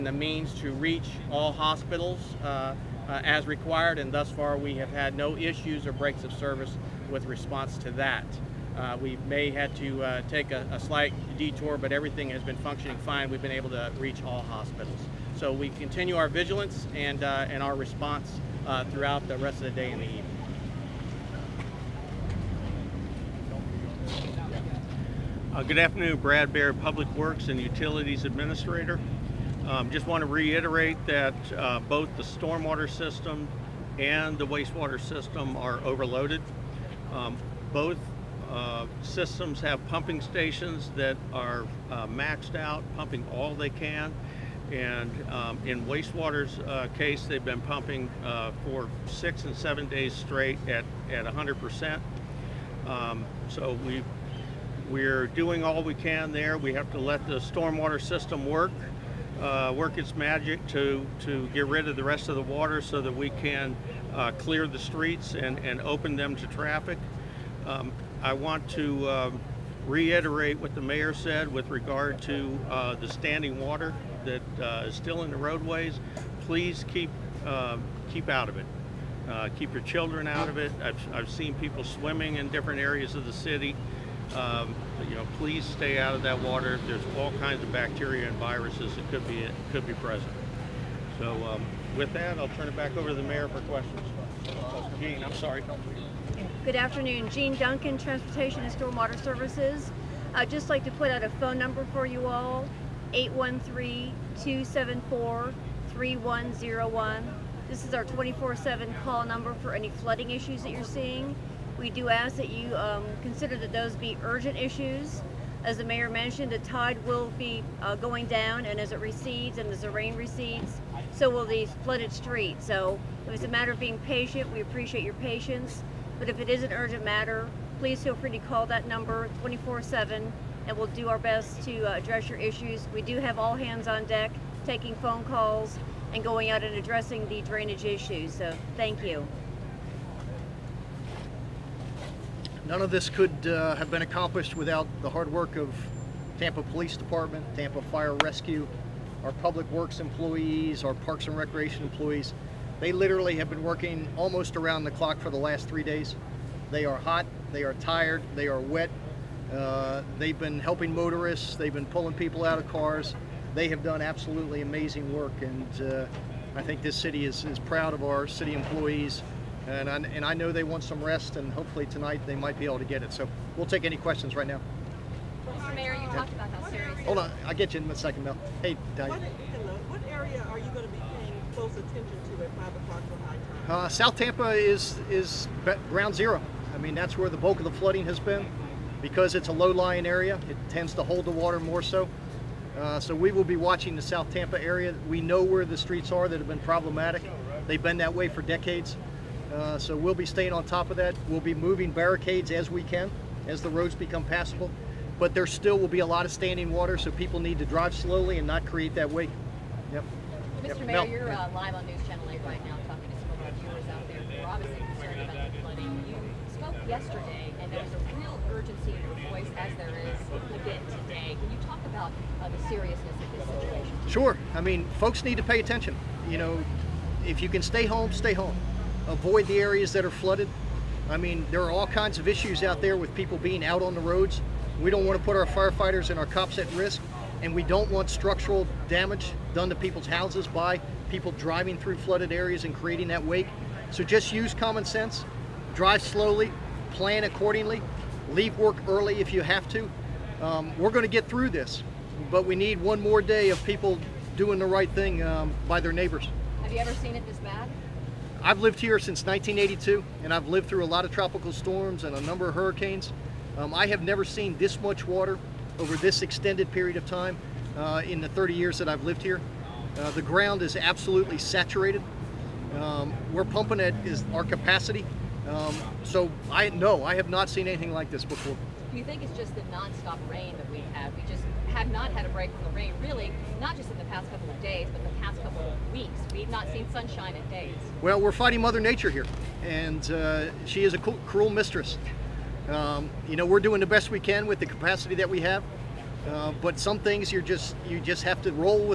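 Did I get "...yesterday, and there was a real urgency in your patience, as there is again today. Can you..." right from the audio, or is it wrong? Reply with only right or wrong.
wrong.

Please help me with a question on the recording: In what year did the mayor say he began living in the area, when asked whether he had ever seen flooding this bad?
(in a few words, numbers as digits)
1982.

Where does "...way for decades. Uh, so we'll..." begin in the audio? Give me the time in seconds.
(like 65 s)
198 s.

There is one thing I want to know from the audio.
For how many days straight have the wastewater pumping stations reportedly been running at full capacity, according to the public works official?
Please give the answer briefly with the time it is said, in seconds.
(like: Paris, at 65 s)
6 and 7, at 49 s.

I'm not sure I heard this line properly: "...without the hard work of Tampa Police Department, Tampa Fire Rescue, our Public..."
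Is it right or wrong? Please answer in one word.
right.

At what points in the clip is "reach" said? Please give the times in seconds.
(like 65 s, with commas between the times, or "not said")
0 s, 13 s.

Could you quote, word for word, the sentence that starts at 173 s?
So we'll take any questions right now.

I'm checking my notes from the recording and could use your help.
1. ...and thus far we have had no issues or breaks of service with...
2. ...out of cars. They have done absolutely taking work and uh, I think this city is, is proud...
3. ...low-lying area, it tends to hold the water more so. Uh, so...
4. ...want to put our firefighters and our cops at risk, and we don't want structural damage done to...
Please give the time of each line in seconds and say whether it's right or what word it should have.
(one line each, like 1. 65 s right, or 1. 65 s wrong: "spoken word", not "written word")
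1. 3 s right
2. 162 s wrong: "amazing", not "taking"
3. 189 s right
4. 235 s right.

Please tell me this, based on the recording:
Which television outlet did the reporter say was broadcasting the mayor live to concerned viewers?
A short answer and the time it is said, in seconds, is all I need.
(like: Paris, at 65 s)
News Channel 8, at 211 s.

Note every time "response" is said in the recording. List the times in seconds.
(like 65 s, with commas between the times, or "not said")
7 s, 17 s.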